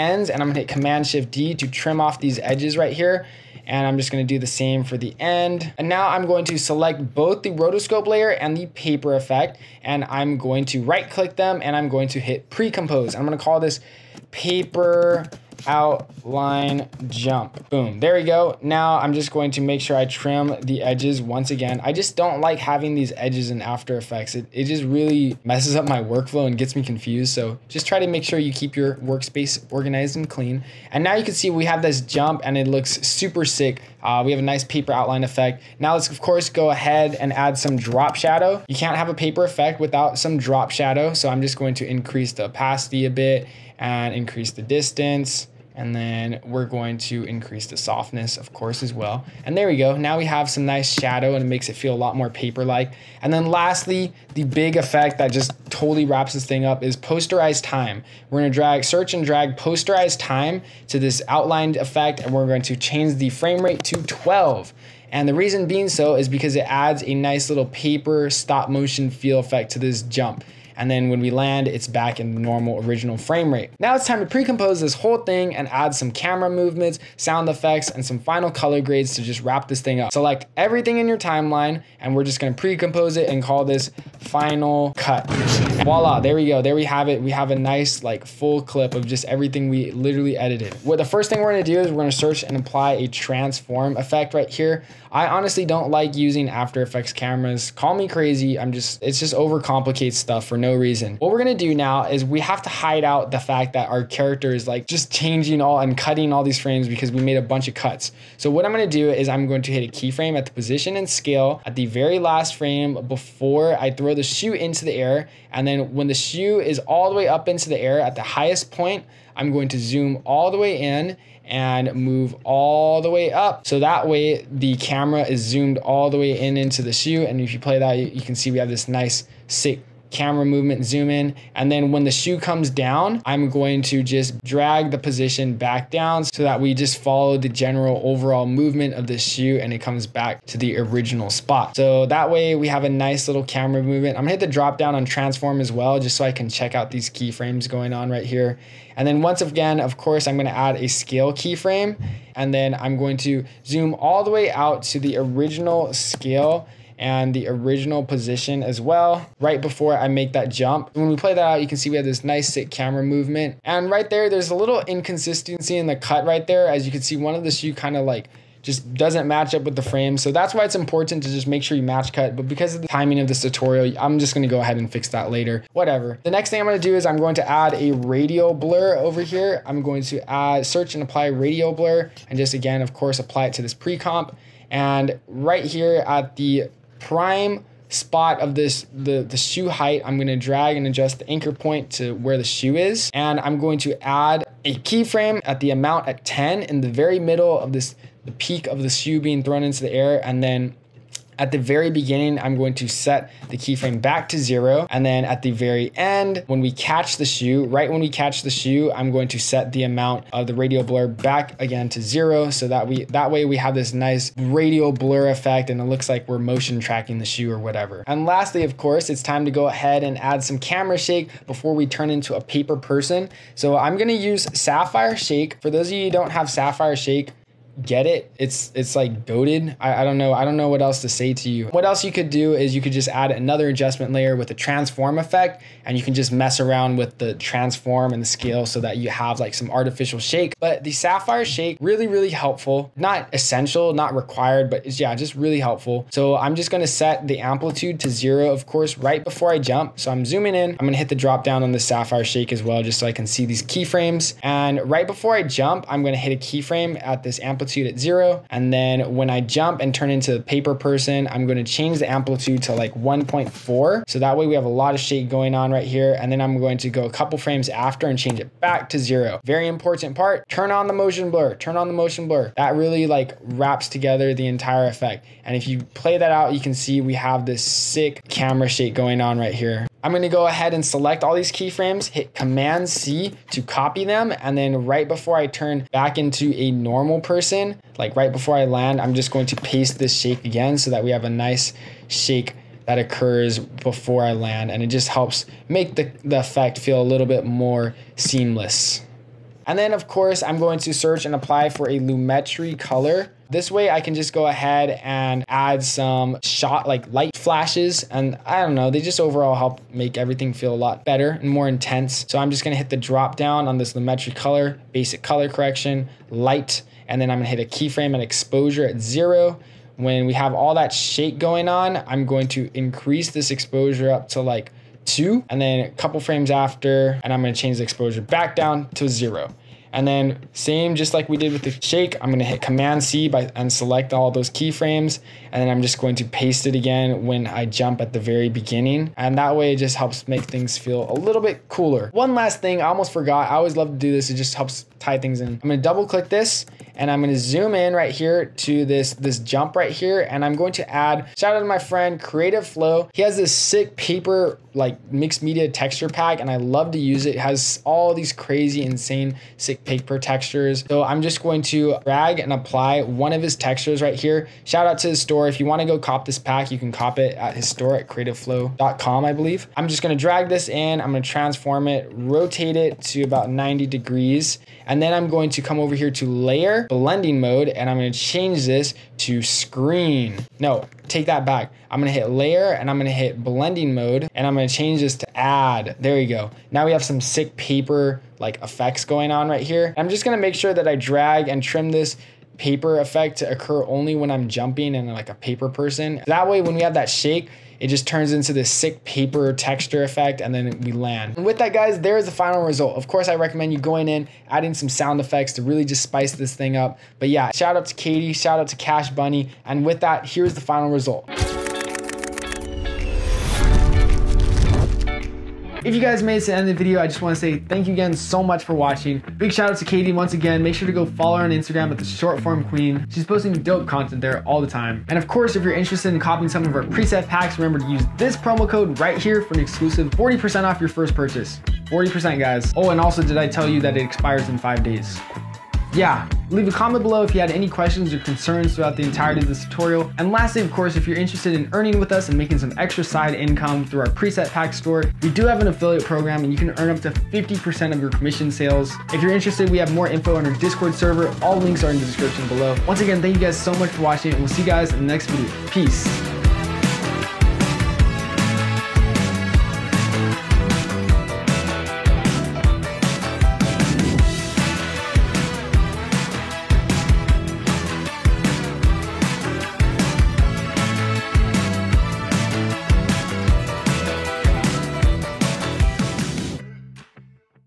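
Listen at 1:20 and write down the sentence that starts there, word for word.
Select everything in your timeline, and we're just gonna pre-compose it and call this final cut.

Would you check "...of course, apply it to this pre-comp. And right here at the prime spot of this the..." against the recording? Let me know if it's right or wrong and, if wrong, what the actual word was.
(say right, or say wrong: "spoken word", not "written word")
right.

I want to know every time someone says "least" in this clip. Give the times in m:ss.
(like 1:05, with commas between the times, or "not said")
not said.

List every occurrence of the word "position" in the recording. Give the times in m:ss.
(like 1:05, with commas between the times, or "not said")
1:50, 2:14, 2:38.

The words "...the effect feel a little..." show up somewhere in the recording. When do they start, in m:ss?
4:56.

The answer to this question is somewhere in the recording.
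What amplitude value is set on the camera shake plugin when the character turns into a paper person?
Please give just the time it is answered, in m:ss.
4:22.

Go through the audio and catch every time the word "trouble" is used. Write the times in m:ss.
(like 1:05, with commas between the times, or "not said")
not said.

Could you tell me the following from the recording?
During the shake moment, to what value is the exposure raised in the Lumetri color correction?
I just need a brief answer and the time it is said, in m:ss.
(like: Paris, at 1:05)
2, at 5:25.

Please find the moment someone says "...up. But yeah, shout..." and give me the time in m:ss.
6:46.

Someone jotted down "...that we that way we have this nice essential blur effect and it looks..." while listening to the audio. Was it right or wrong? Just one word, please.
wrong.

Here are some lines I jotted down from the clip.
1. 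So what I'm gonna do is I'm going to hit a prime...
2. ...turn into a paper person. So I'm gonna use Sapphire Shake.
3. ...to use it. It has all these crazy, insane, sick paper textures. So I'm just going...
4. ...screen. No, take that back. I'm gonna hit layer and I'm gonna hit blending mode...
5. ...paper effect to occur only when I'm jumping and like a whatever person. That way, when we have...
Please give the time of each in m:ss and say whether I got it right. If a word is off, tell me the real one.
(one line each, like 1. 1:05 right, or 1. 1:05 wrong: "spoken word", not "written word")
1. 1:48 wrong: "keyframe", not "prime"
2. 3:41 right
3. 5:56 right
4. 6:19 right
5. 6:32 wrong: "paper", not "whatever".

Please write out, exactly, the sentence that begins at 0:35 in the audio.
Now let's of course go ahead and add some drop shadow.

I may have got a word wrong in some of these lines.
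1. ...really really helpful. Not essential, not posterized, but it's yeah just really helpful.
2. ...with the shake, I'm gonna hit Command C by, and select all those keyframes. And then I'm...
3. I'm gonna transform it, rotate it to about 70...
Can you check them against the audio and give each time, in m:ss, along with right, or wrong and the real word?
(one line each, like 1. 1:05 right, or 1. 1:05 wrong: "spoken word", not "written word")
1. 4:01 wrong: "required", not "posterized"
2. 5:31 right
3. 6:11 wrong: "90", not "70".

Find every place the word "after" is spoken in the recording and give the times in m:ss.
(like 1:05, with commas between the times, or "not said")
0:23, 1:36, 4:27, 5:26.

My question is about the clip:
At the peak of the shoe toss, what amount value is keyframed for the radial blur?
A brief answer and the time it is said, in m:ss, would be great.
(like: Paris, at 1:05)
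10, at 3:16.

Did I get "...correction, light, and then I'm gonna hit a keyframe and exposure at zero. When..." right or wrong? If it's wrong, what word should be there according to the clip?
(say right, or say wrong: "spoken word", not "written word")
right.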